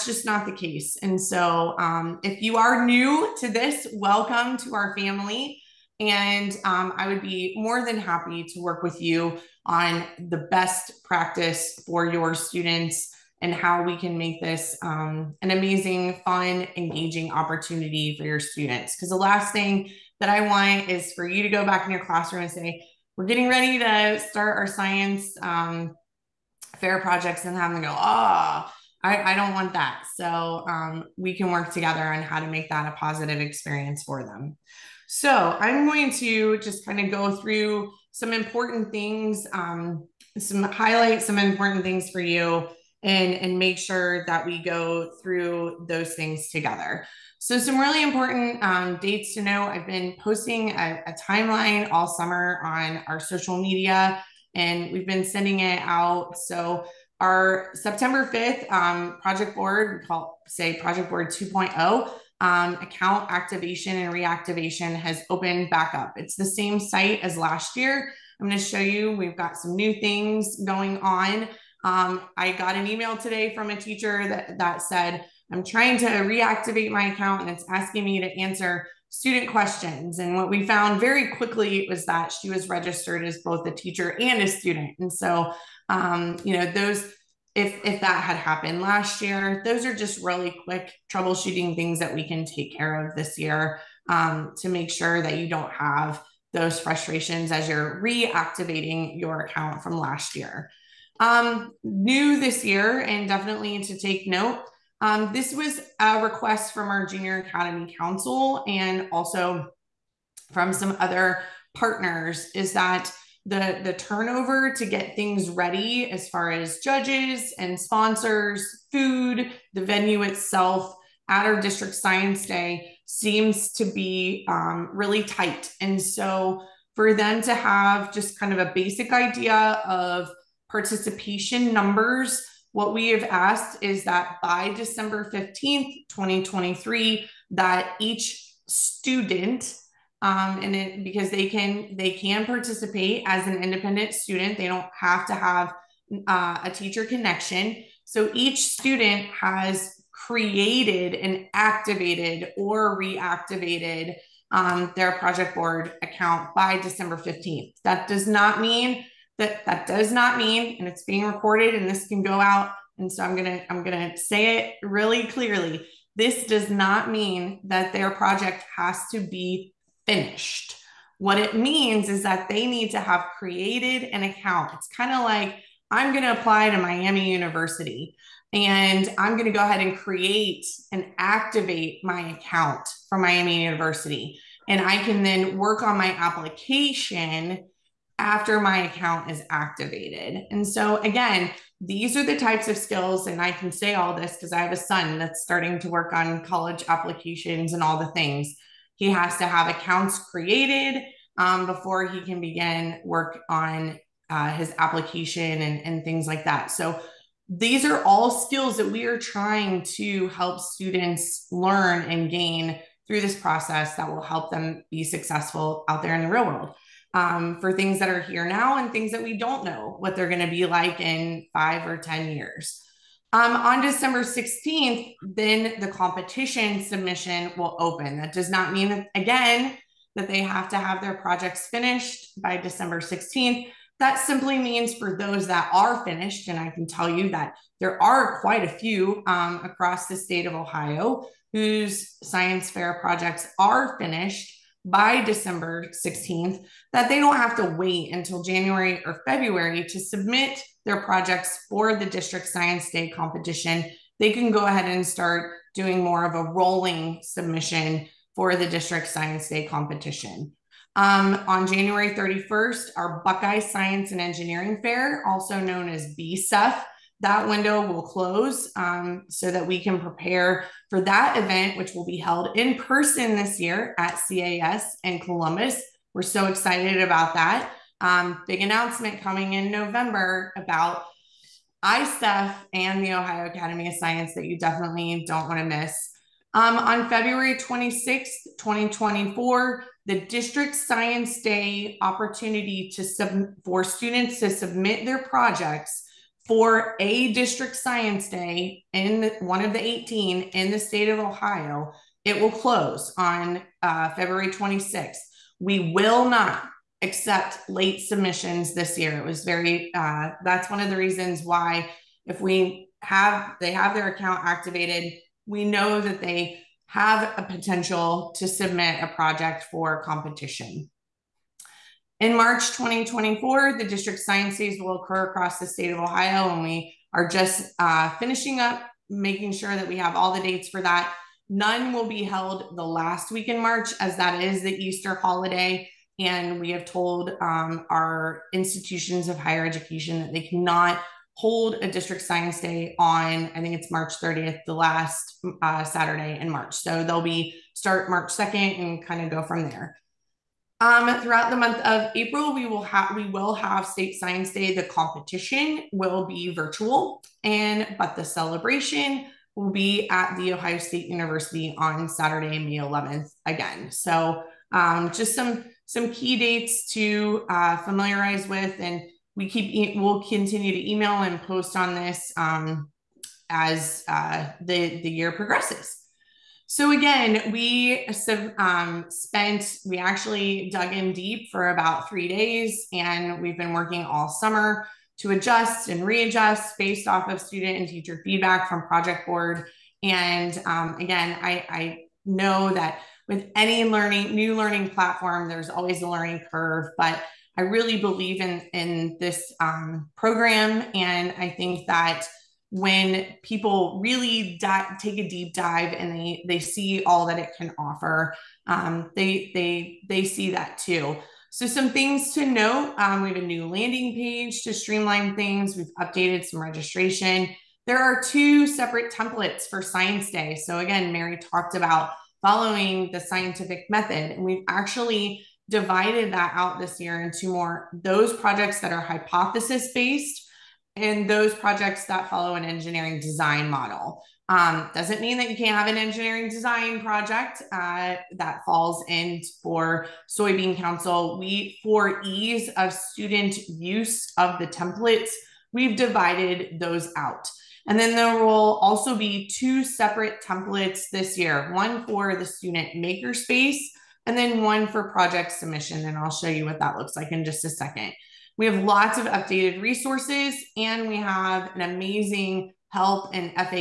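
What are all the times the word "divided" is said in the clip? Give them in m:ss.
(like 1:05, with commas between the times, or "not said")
7:05, 7:25.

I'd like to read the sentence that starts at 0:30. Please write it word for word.
So um, we can work together on how to make that a positive experience for them.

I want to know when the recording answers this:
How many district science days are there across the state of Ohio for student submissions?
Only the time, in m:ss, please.
4:59.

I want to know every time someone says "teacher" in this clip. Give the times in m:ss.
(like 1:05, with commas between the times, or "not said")
1:13, 1:23, 2:26, 6:27.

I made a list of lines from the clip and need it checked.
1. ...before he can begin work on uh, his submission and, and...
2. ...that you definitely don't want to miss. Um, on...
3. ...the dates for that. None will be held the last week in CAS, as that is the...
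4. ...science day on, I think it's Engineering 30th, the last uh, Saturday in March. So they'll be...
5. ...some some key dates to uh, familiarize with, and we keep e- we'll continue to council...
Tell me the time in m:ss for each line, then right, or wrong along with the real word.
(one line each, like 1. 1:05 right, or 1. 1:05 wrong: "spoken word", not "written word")
1. 3:21 wrong: "application", not "submission"
2. 4:44 right
3. 5:30 wrong: "March", not "CAS"
4. 5:42 wrong: "March", not "Engineering"
5. 6:05 wrong: "email", not "council".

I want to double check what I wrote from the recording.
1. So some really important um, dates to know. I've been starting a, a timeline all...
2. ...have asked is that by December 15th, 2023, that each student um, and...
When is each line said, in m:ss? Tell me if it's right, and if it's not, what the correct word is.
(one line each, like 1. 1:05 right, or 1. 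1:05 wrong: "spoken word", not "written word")
1. 0:47 wrong: "posting", not "starting"
2. 2:13 right.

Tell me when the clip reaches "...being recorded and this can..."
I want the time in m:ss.
2:41.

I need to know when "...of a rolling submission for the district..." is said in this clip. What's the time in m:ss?
4:16.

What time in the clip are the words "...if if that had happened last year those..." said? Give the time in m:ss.
1:27.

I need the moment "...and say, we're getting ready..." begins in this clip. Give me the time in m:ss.
0:22.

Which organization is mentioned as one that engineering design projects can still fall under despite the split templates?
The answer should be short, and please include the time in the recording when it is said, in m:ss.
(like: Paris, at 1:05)
Soybean Council, at 7:20.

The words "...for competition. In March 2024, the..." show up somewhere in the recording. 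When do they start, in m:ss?
5:19.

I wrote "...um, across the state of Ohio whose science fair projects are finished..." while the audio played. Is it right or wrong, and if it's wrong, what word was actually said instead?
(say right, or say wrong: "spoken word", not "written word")
right.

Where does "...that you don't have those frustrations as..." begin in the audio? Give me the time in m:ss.
1:35.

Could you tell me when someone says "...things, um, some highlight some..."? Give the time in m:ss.
0:38.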